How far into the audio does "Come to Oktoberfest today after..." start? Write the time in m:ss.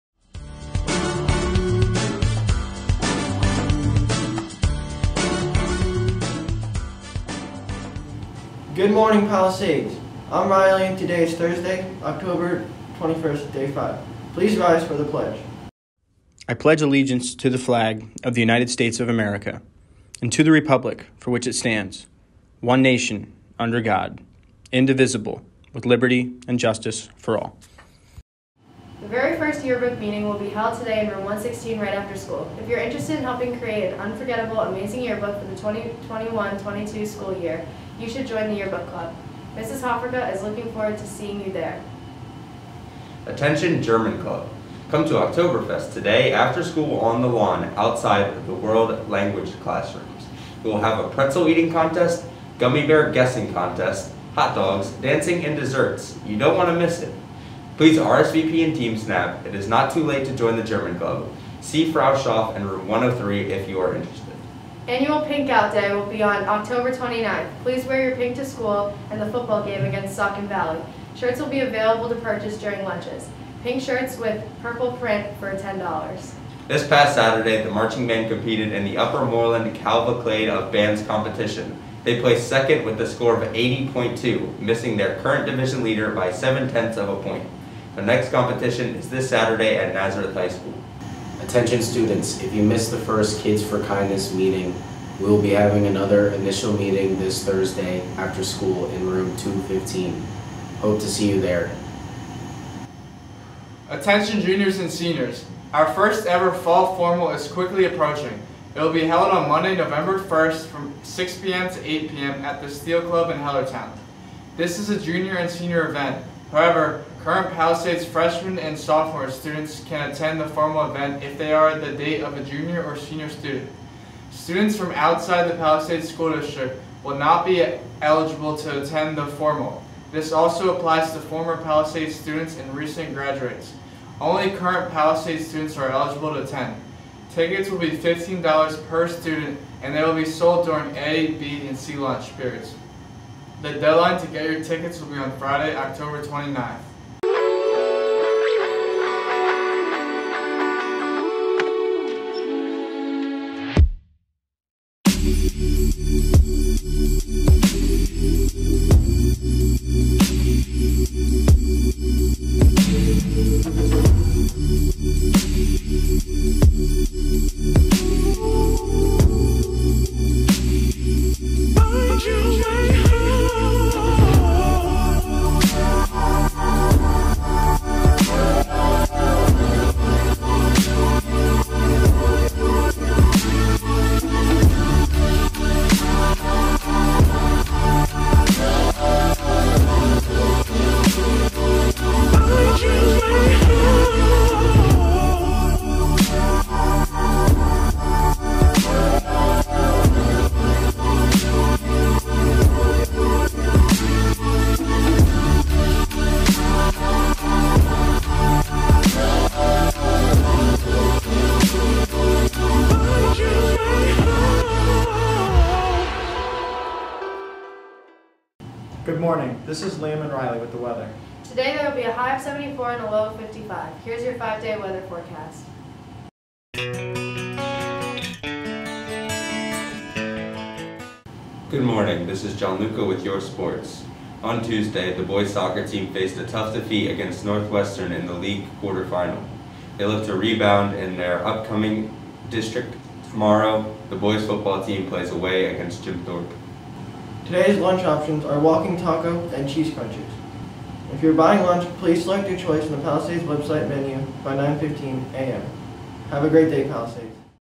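0:44.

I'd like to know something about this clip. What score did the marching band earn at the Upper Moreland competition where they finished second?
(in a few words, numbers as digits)
80.2.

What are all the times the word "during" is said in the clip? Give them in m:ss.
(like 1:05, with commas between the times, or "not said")
1:12, 2:20.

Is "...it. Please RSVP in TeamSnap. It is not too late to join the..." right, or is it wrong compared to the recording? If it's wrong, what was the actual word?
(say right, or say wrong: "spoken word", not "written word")
right.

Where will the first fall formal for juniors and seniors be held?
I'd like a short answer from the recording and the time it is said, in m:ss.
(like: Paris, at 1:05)
Steel Club in Hellertown, at 1:52.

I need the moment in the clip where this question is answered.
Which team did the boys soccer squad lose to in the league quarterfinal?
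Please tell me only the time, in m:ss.
3:57.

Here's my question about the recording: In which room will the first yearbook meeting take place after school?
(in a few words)
116.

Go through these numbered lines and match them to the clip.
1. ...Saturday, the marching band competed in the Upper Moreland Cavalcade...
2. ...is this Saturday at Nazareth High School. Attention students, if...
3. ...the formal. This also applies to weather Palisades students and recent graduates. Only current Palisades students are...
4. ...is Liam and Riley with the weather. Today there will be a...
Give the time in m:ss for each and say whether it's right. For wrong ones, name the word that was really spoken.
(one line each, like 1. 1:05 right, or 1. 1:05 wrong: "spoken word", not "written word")
1. 1:17 right
2. 1:28 right
3. 2:09 wrong: "former", not "weather"
4. 3:39 right.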